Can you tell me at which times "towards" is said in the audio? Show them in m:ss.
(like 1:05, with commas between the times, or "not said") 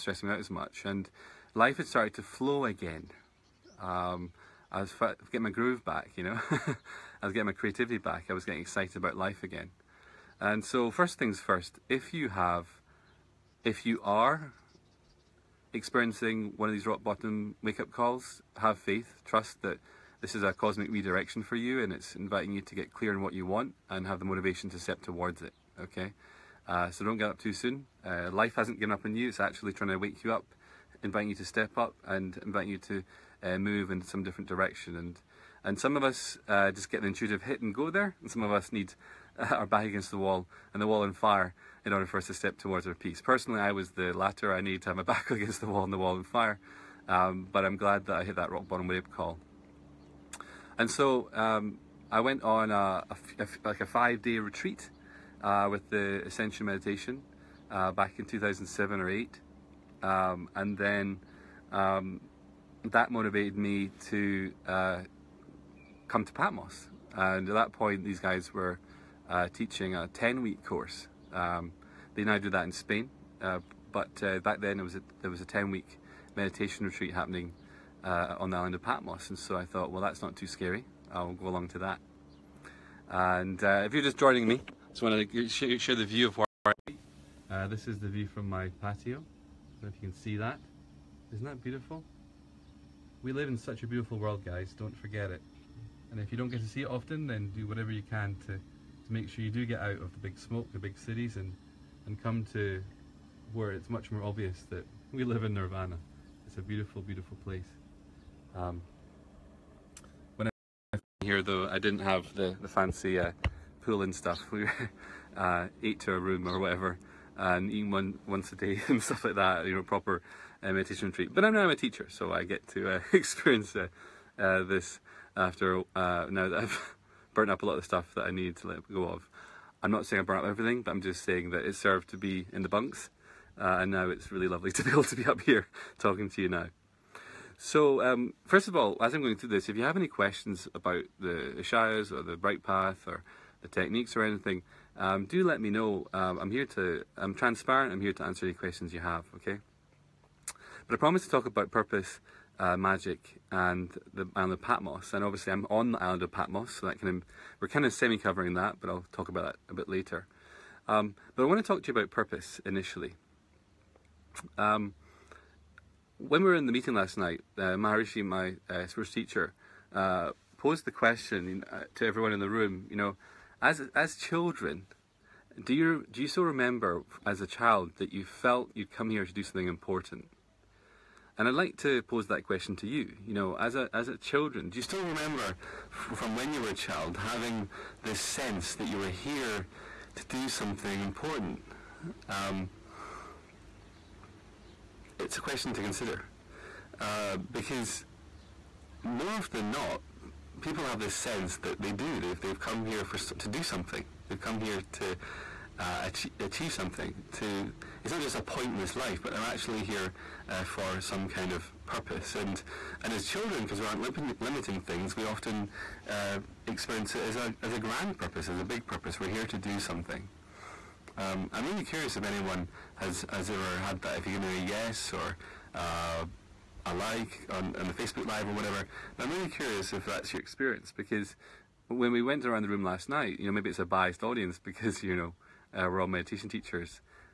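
0:25, 0:42.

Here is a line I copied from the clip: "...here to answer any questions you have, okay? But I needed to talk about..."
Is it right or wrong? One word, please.
wrong.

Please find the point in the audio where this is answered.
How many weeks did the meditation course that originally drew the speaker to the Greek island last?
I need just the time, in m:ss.
1:10.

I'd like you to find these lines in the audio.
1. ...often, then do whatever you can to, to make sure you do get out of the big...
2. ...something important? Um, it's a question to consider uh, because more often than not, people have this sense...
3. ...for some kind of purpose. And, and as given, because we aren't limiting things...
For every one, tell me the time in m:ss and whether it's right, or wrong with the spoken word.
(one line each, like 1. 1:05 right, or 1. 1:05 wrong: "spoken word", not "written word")
1. 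1:36 right
2. 3:10 right
3. 3:30 wrong: "children", not "given".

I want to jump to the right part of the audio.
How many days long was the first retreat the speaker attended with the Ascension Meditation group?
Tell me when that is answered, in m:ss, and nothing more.
0:53.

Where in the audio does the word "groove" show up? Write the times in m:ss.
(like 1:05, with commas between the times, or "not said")
0:05.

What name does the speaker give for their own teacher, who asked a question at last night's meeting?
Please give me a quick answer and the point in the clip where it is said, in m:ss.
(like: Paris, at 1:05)
Maharishi, at 2:47.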